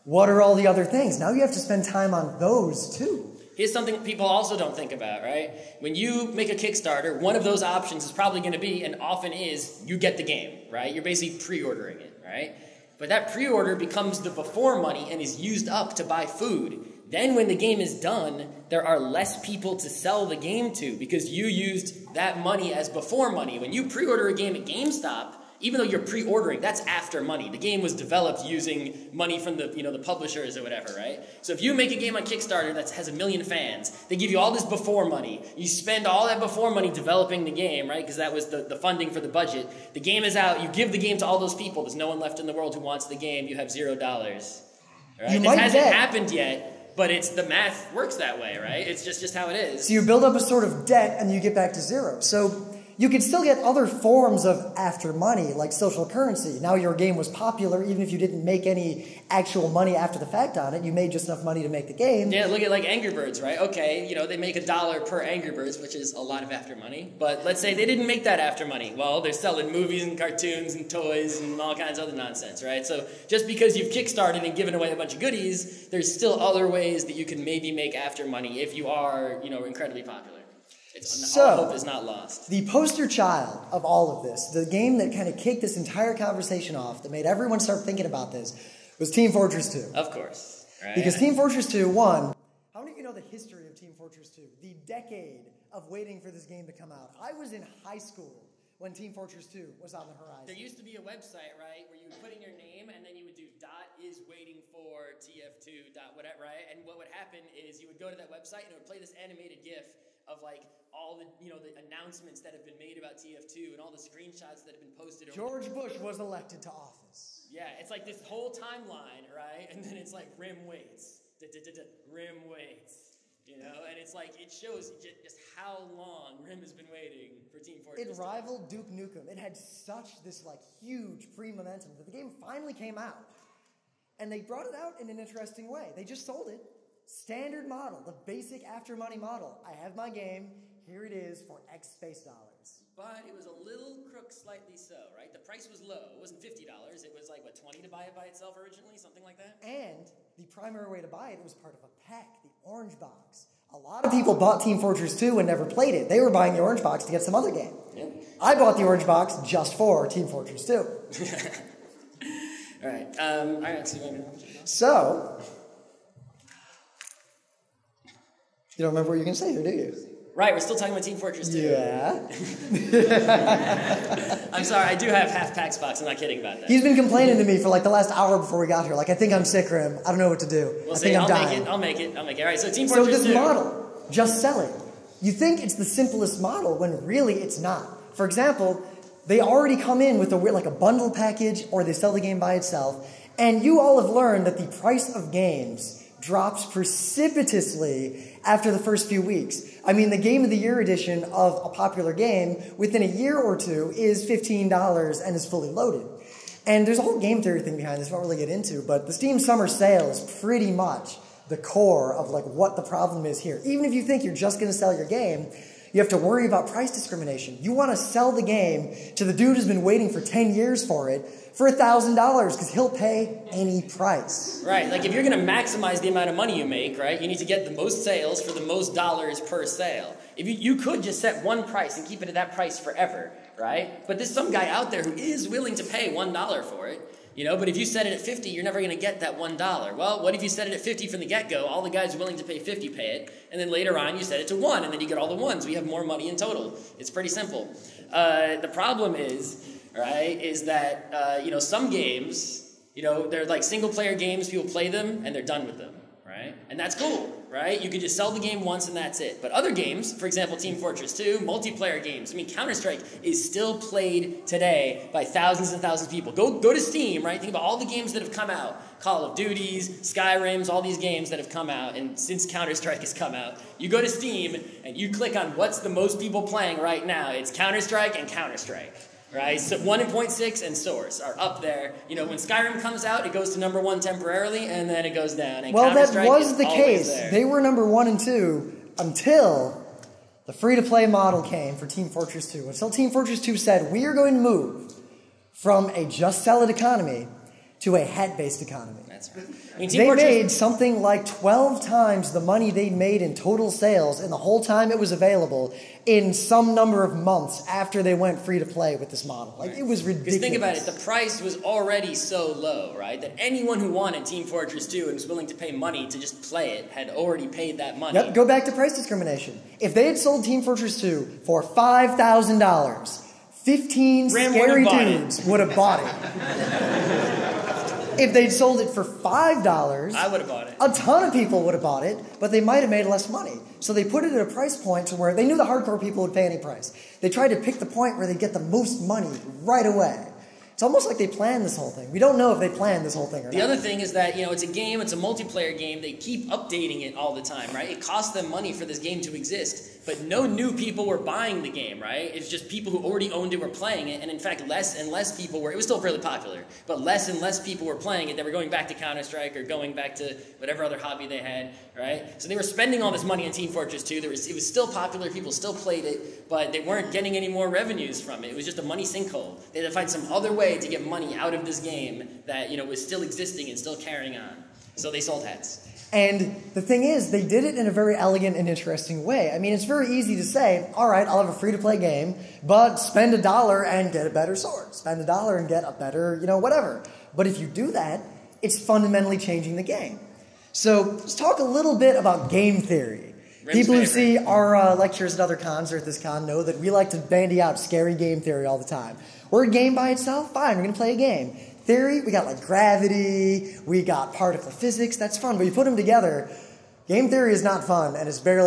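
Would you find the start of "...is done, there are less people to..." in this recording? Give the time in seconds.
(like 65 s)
17 s.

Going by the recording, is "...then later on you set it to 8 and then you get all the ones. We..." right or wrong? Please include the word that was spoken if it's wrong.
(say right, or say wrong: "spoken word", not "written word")
wrong: "1", not "8".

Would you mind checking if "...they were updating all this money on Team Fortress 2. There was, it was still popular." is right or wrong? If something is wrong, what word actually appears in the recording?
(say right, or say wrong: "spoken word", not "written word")
wrong: "spending", not "updating".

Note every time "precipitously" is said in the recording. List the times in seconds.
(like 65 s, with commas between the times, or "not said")
196 s.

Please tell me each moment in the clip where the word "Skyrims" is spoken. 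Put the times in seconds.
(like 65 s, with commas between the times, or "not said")
270 s, 282 s.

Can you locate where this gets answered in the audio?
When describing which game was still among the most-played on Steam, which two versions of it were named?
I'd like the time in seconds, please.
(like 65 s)
279 s.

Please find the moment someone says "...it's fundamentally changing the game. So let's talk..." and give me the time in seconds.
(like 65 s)
388 s.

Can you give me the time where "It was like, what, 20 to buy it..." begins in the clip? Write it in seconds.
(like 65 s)
147 s.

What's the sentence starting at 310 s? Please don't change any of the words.
Think about it the price was already so low, right?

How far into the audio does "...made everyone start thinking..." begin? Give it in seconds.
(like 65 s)
87 s.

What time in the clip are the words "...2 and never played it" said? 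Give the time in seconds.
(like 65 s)
155 s.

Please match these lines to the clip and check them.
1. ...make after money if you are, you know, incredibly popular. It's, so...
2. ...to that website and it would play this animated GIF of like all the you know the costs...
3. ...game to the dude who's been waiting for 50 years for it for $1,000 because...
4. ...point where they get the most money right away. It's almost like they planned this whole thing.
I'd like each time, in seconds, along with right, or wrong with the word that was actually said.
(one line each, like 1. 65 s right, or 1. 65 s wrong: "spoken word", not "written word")
1. 77 s right
2. 108 s wrong: "announcements", not "costs"
3. 218 s wrong: "10", not "50"
4. 337 s right.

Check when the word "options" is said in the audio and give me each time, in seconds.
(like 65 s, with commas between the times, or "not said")
7 s.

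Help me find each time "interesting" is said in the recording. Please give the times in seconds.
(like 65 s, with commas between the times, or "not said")
135 s, 378 s.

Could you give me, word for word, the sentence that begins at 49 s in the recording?
So you build up a sort of debt and you get back to zero.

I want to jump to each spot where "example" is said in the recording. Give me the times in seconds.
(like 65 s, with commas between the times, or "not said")
188 s, 260 s.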